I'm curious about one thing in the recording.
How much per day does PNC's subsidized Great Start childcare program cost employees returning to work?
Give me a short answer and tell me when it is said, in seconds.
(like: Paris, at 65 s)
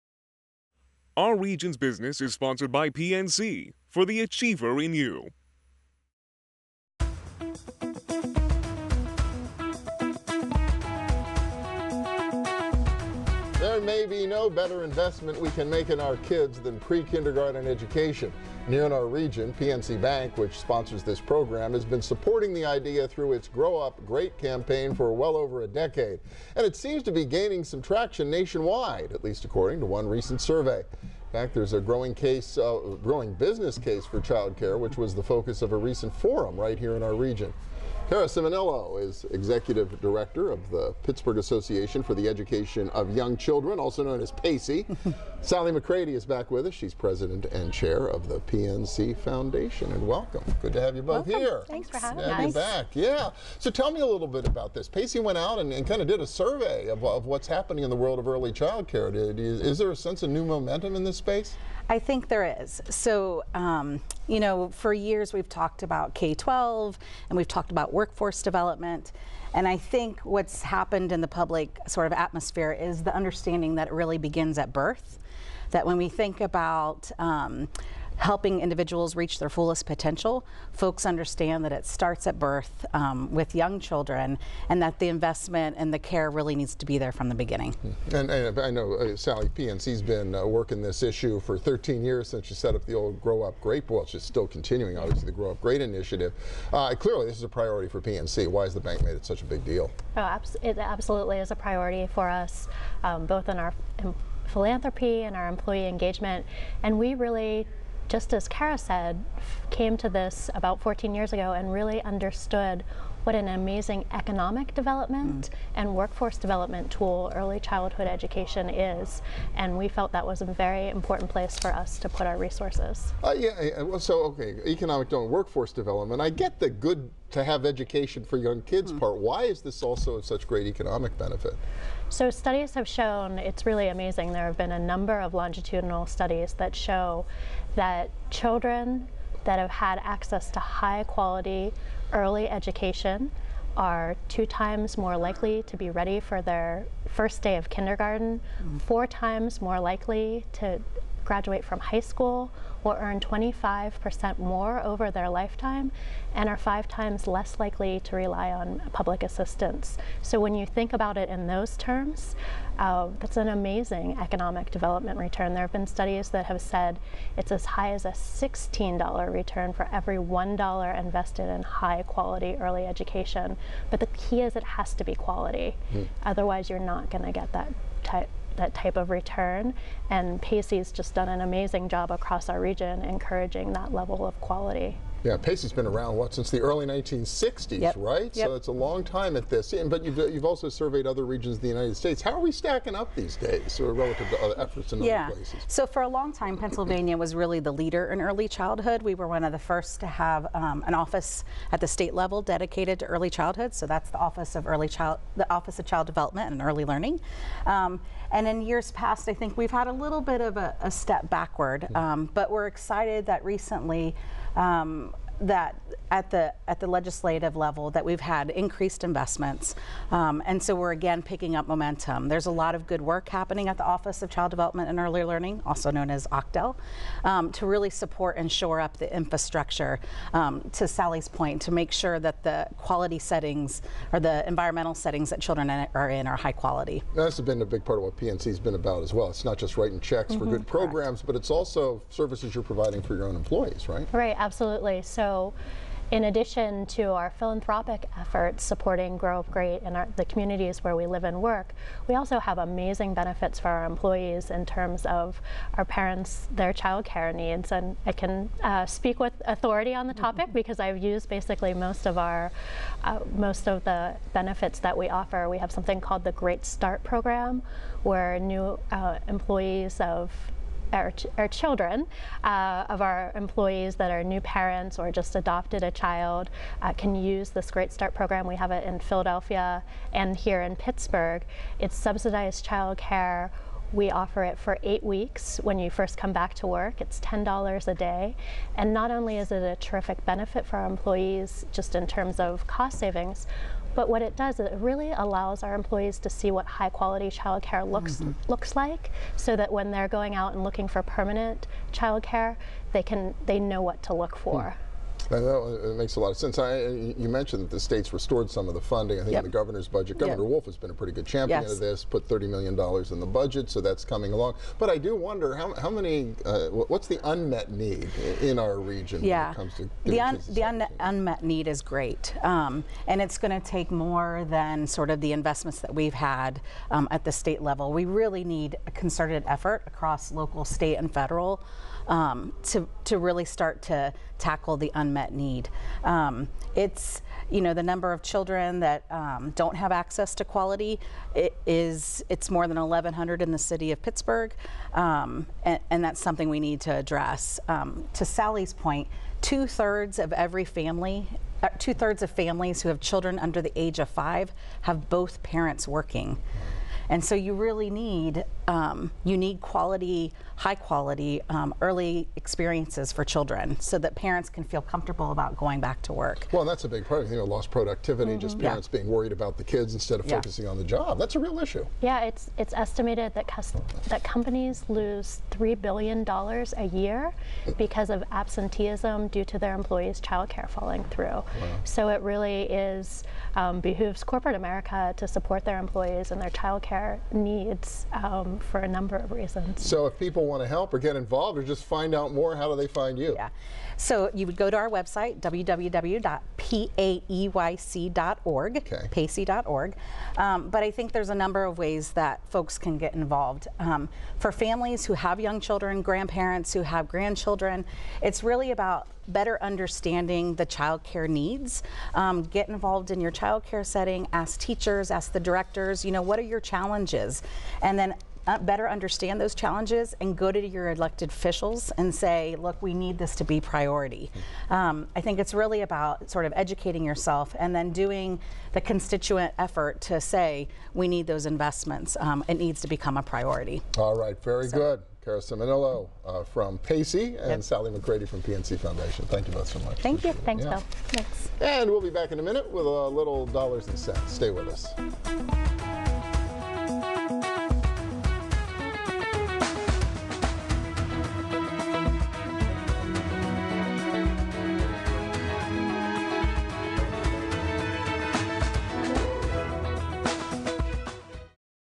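$10, at 287 s.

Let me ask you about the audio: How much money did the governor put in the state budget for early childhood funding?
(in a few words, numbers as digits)
$30 million.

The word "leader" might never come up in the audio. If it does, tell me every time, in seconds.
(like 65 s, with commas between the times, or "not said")
197 s.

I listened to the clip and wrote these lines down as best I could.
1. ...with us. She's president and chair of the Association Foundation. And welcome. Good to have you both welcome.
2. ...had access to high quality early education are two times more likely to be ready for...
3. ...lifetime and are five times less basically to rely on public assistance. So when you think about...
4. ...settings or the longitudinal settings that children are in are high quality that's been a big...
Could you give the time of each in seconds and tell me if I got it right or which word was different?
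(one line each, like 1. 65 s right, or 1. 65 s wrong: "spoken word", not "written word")
1. 46 s wrong: "PNC", not "Association"
2. 139 s right
3. 155 s wrong: "likely", not "basically"
4. 233 s wrong: "environmental", not "longitudinal".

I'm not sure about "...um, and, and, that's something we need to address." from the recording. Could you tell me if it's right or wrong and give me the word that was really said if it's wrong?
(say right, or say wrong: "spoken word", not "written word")
right.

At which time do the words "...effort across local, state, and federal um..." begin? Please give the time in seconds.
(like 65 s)
329 s.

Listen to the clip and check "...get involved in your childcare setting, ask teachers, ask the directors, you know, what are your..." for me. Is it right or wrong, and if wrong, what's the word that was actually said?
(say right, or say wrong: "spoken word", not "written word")
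right.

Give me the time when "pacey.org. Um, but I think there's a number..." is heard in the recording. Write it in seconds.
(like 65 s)
399 s.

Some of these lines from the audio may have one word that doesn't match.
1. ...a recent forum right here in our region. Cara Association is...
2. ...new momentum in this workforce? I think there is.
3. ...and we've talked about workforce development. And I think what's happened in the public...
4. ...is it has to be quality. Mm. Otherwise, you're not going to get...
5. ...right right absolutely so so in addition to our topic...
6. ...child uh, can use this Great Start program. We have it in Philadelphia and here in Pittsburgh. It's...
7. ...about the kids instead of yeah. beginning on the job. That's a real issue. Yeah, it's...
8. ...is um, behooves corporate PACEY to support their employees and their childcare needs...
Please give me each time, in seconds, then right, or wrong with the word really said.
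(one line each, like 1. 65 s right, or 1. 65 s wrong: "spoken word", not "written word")
1. 35 s wrong: "Ciminillo", not "Association"
2. 60 s wrong: "space", not "workforce"
3. 67 s right
4. 174 s right
5. 243 s wrong: "philanthropic", not "topic"
6. 275 s right
7. 369 s wrong: "focusing", not "beginning"
8. 382 s wrong: "America", not "PACEY".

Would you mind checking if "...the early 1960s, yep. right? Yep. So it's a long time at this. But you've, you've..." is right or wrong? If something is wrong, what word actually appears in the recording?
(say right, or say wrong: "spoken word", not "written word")
right.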